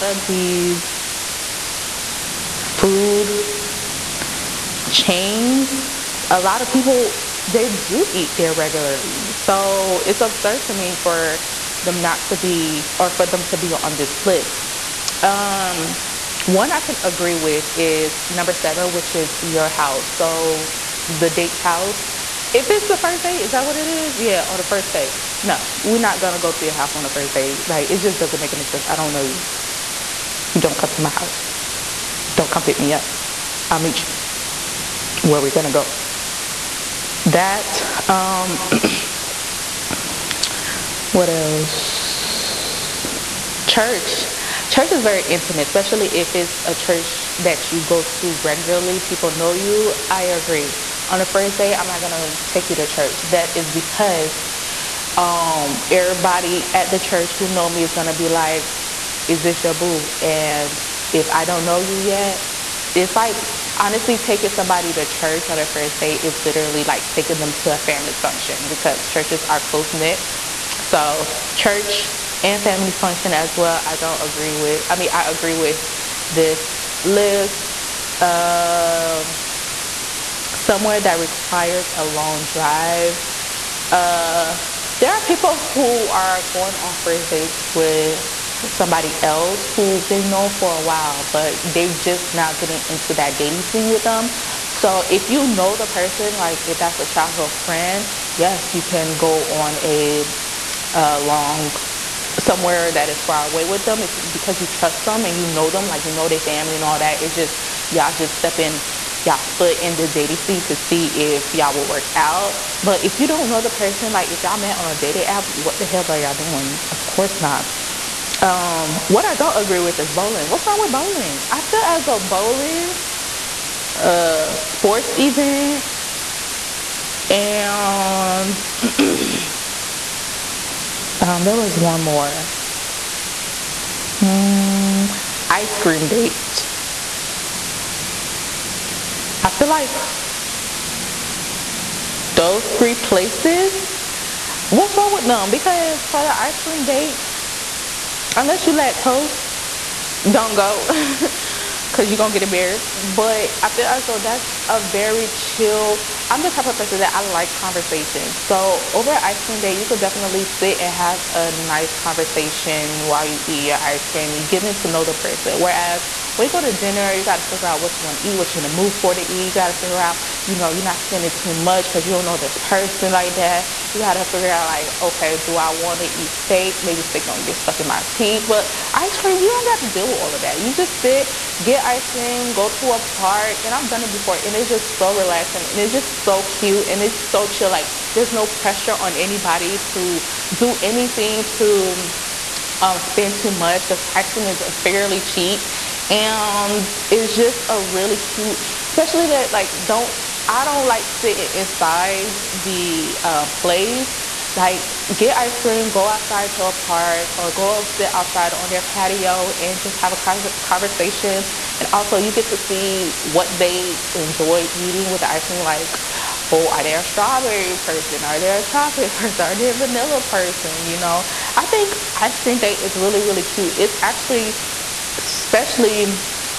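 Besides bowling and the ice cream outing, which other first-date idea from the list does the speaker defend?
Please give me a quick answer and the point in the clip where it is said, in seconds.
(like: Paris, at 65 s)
Sports event, at 124 s.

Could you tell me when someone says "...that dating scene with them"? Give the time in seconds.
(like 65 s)
93 s.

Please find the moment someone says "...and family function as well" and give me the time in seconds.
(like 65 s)
72 s.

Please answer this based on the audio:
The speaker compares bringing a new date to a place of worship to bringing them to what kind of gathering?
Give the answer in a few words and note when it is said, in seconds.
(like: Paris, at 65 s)
A family function, at 67 s.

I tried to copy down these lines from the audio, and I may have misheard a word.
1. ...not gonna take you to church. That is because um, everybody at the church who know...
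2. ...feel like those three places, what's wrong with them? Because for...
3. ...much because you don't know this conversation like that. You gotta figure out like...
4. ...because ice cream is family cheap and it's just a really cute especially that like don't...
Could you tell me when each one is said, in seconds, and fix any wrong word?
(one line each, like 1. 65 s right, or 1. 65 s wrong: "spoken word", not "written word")
1. 51 s right
2. 139 s right
3. 171 s wrong: "person", not "conversation"
4. 193 s wrong: "fairly", not "family".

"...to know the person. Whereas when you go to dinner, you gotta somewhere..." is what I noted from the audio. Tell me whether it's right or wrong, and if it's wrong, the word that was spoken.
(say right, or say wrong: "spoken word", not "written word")
wrong: "figure", not "somewhere".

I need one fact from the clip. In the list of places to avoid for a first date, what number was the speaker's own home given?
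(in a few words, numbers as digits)
7.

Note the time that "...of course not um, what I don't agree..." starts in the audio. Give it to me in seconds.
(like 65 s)
116 s.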